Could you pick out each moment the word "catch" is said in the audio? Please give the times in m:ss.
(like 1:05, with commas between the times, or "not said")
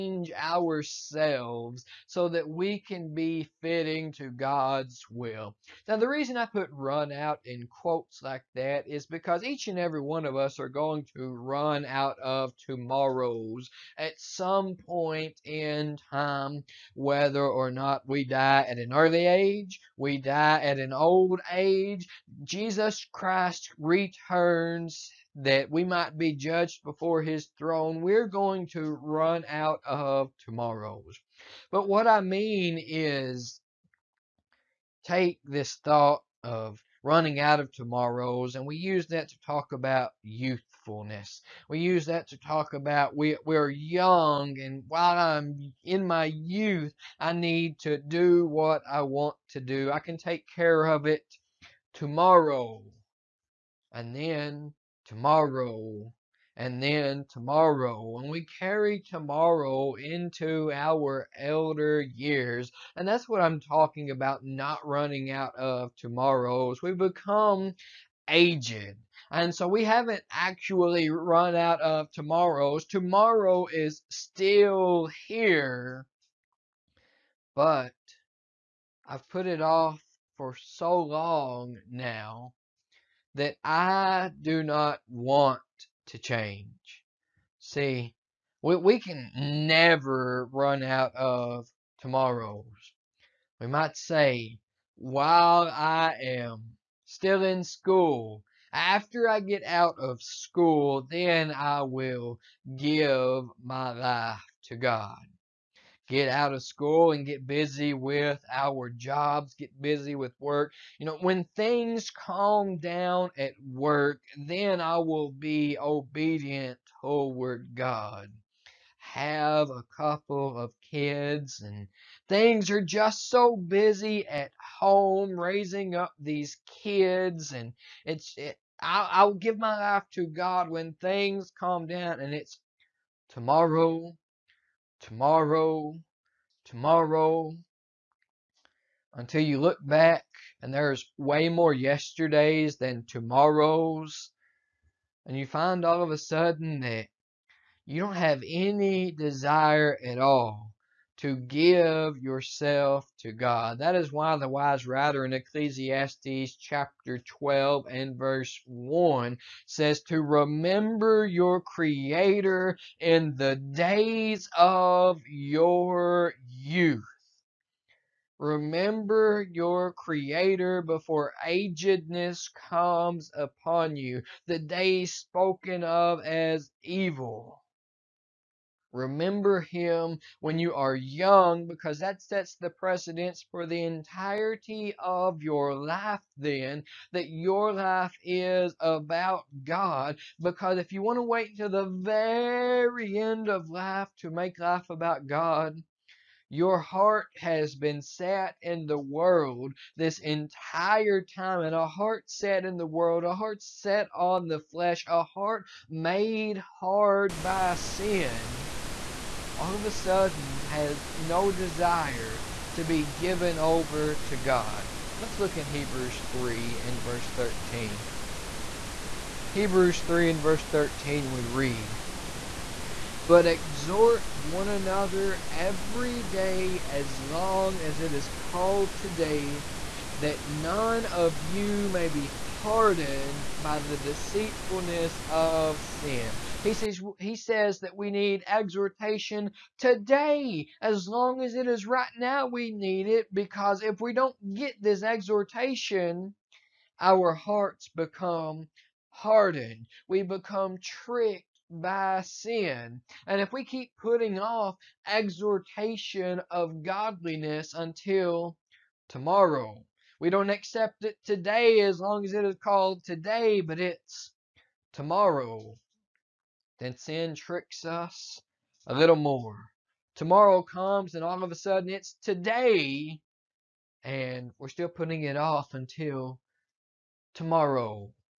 not said.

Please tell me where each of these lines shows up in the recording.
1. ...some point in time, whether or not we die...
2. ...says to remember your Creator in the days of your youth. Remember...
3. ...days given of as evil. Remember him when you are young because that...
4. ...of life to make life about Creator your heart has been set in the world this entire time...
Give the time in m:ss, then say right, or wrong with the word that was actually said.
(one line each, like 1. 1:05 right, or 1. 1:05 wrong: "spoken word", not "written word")
1. 0:14 right
2. 2:39 right
3. 2:54 wrong: "spoken", not "given"
4. 3:13 wrong: "God", not "Creator".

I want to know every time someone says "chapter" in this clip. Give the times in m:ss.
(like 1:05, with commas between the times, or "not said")
2:36.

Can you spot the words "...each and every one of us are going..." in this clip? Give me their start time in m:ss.
0:09.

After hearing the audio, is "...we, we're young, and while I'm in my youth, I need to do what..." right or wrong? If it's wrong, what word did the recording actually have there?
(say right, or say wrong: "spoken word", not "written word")
right.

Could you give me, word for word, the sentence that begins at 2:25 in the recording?
And you find all of a sudden that you don't have any desire at all to give yourself to God.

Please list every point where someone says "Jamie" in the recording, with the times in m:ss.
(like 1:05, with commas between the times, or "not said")
not said.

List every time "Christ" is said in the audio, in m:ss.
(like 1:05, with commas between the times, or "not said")
0:23.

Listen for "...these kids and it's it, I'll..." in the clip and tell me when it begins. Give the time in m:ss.
2:06.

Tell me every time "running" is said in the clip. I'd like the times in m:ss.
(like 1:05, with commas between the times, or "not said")
0:37, 1:04.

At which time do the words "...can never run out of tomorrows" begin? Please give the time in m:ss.
1:29.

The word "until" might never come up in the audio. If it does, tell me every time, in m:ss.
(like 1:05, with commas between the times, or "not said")
2:19, 4:17, 4:35.